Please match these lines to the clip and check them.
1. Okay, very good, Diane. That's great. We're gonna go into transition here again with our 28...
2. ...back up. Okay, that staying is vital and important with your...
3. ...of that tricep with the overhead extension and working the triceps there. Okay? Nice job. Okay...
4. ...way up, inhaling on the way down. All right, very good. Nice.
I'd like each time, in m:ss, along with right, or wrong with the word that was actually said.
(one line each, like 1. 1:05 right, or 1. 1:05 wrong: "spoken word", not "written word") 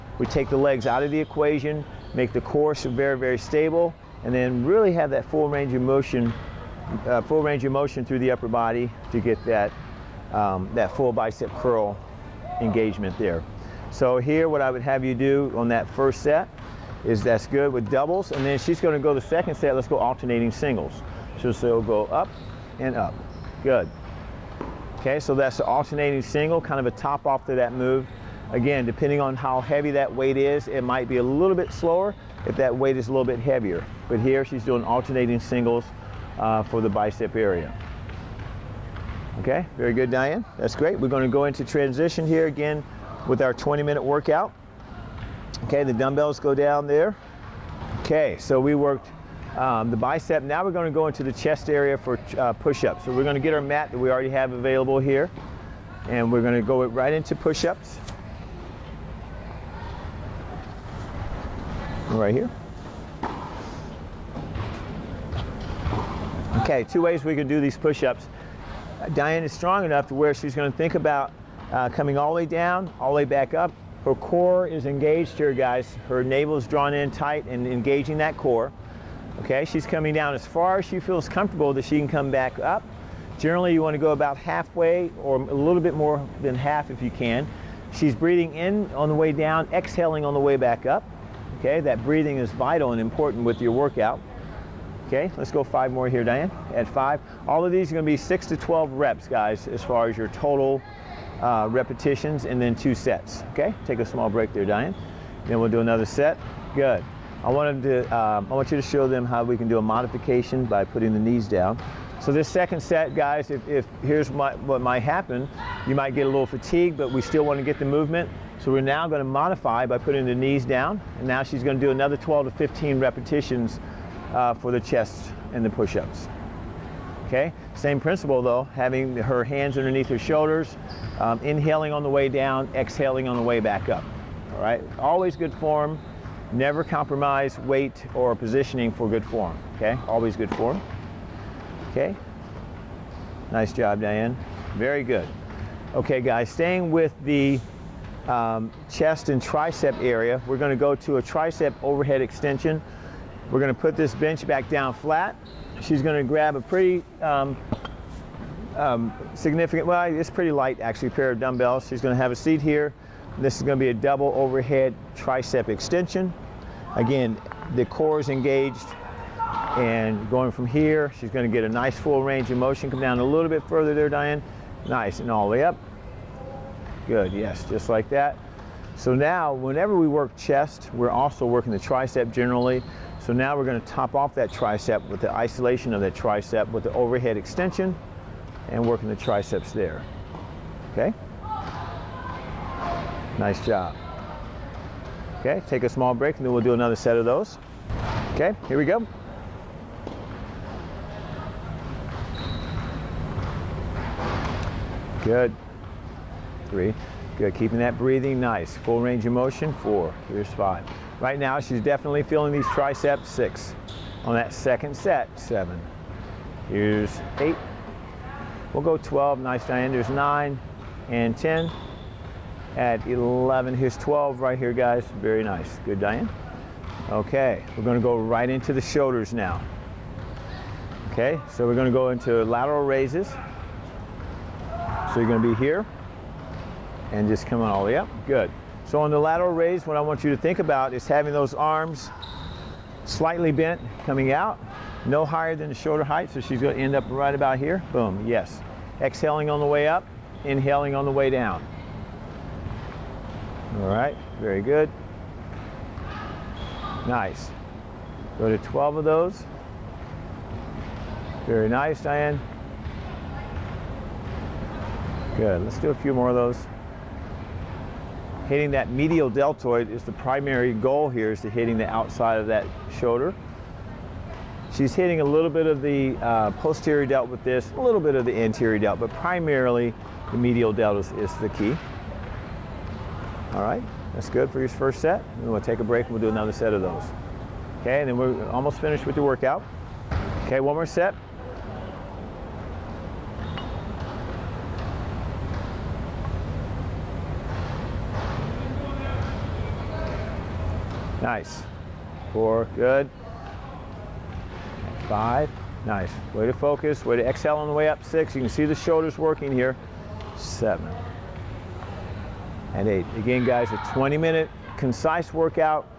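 1. 0:39 wrong: "20", not "28"
2. 1:30 wrong: "breathing", not "staying"
3. 3:05 right
4. 4:09 right.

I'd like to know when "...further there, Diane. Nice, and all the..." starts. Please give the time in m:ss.
2:53.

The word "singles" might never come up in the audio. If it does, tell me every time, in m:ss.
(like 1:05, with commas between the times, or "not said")
0:20, 0:26, 0:35.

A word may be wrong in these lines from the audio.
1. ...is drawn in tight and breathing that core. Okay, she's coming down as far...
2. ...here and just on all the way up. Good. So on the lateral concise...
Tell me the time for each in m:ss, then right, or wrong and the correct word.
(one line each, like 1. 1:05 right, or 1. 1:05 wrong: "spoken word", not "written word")
1. 1:16 wrong: "engaging", not "breathing"
2. 3:55 wrong: "raise", not "concise".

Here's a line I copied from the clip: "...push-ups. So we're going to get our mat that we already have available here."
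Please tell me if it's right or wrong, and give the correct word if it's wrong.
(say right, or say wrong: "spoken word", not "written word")
right.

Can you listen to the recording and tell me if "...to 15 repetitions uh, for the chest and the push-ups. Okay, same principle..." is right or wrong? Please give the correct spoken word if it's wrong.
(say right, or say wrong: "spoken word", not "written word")
right.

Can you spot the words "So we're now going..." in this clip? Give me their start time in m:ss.
1:58.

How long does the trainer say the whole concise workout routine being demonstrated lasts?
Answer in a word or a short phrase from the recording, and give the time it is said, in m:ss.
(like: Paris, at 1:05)
20 minutes, at 5:13.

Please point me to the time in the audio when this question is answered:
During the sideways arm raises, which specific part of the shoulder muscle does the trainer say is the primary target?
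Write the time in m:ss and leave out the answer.
4:28.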